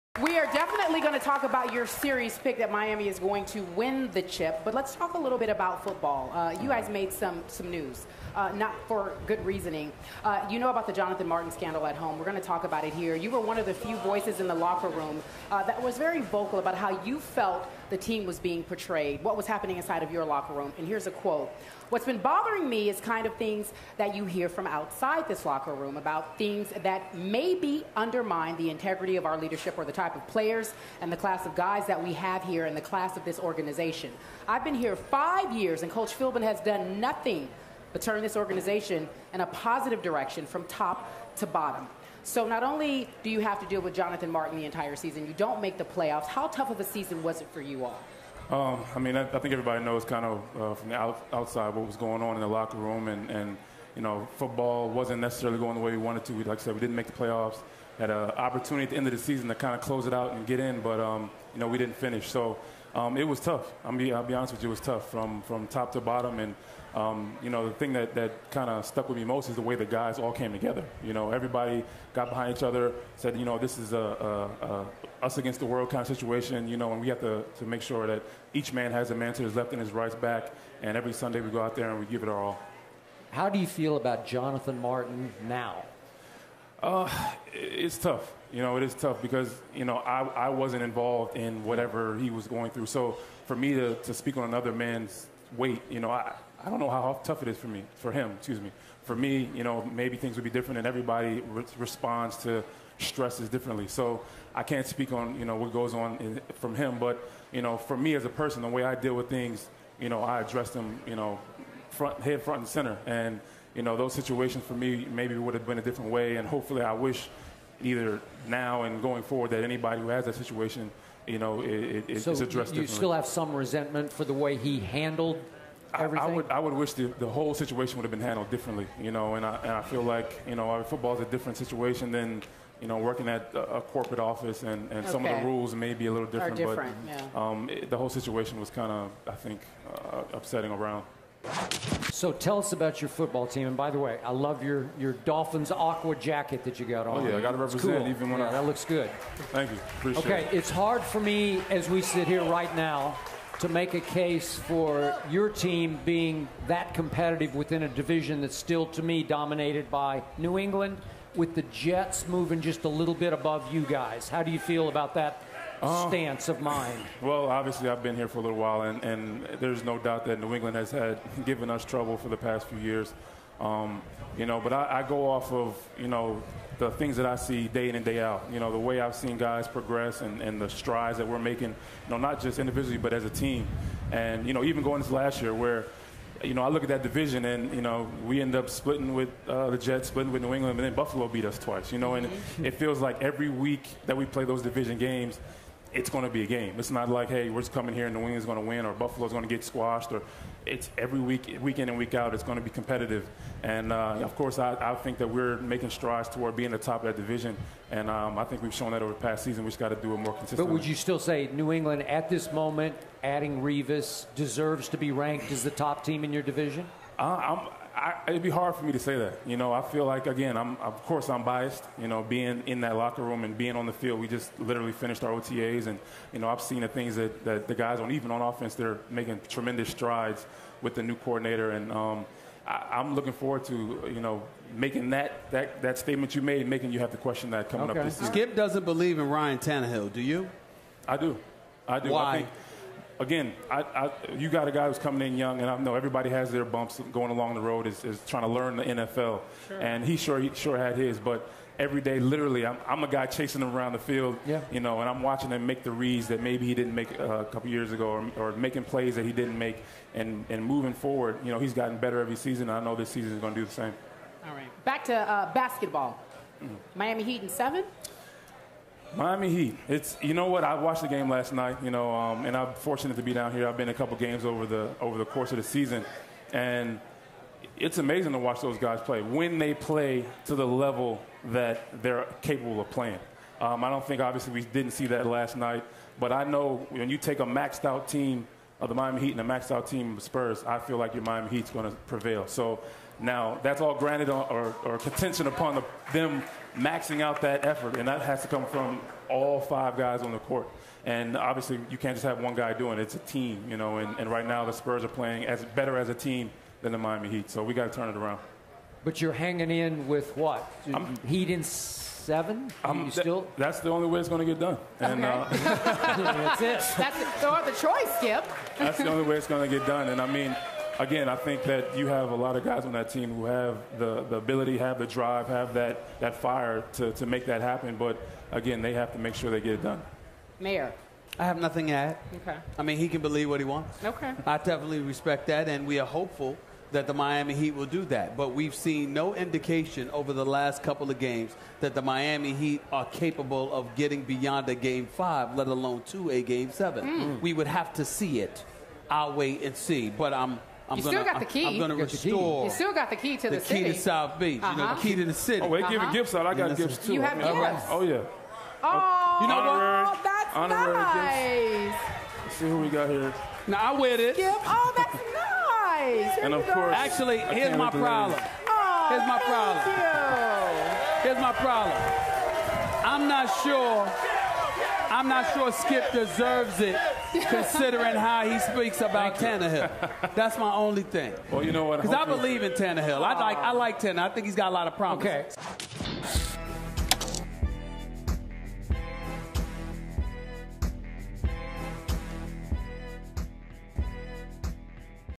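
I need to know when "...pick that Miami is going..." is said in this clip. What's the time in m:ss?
0:02.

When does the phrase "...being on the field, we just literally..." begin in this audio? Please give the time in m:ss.
3:43.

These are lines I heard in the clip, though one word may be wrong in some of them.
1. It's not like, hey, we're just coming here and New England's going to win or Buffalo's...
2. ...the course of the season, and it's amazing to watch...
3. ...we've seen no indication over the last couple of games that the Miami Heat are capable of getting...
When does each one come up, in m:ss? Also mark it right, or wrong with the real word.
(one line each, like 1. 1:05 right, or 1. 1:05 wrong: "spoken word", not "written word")
1. 3:16 right
2. 4:35 right
3. 5:38 right.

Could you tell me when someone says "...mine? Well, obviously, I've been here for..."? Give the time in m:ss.
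2:46.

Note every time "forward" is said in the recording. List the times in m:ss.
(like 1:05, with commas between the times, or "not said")
1:59, 3:53, 4:20.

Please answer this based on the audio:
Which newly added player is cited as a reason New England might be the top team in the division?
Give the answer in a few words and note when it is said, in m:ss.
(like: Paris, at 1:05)
Revis, at 3:33.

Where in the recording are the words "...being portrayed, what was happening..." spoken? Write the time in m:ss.
0:18.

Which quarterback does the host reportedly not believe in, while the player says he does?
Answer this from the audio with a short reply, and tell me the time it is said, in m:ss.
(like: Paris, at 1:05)
Ryan Tannehill, at 3:59.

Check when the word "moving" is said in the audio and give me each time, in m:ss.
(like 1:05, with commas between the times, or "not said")
2:42, 4:20.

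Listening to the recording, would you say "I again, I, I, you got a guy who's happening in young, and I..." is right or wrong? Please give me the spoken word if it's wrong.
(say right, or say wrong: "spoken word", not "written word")
wrong: "coming", not "happening".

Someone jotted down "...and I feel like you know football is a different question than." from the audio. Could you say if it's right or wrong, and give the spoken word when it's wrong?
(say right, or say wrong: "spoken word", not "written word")
wrong: "situation", not "question".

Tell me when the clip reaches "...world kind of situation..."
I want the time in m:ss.
1:15.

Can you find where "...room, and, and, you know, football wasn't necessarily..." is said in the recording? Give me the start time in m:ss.
0:52.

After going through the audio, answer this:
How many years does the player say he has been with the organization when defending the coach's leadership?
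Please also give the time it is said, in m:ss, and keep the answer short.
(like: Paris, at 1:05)
5 years, at 0:34.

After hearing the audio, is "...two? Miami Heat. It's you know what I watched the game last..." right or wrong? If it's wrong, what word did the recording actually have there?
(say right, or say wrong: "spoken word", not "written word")
wrong: "seven", not "two".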